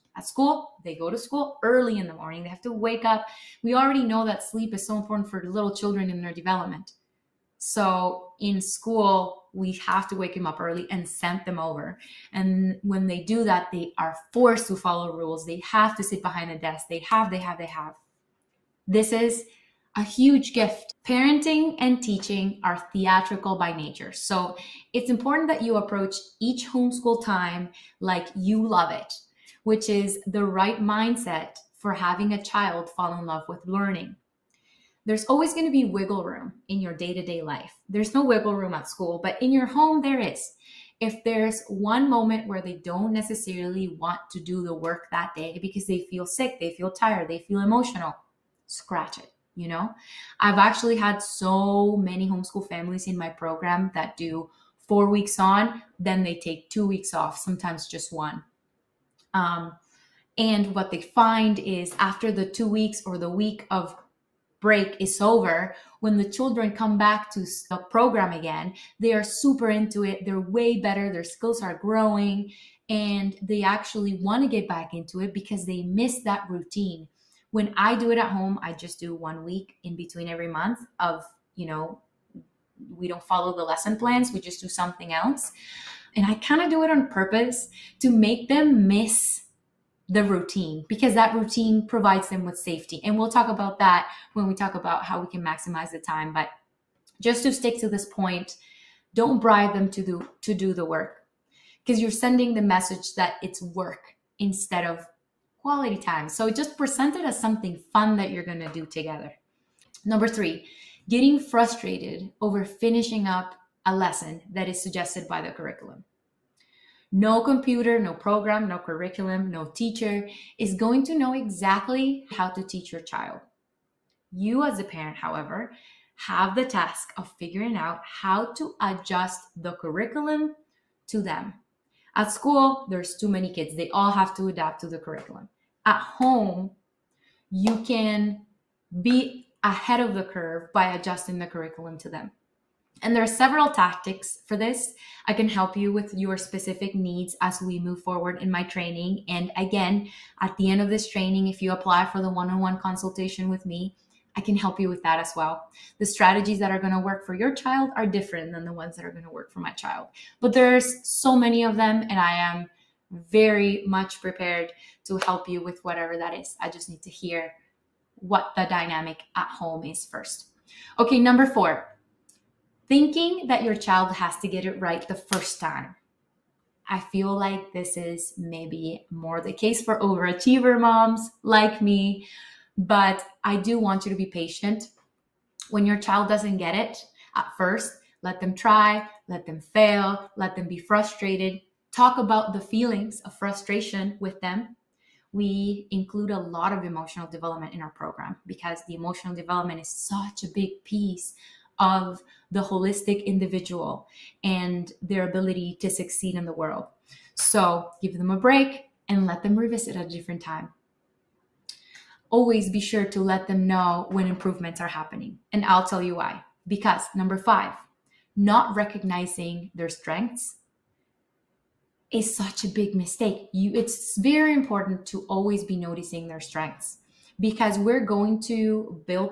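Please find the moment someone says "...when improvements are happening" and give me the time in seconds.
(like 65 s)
214 s.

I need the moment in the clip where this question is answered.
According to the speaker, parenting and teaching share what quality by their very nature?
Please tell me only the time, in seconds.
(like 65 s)
22 s.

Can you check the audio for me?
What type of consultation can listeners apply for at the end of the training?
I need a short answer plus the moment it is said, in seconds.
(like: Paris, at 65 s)
One on one, at 152 s.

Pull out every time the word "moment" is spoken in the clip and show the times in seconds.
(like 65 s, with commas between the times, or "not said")
42 s.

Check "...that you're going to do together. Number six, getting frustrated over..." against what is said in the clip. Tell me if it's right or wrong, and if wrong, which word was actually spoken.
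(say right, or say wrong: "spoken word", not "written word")
wrong: "three", not "six".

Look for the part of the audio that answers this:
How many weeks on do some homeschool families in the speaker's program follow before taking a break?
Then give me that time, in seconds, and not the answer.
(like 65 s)
54 s.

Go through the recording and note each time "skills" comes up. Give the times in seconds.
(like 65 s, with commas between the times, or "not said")
71 s.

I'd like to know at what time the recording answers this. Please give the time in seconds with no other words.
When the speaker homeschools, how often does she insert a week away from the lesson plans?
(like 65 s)
80 s.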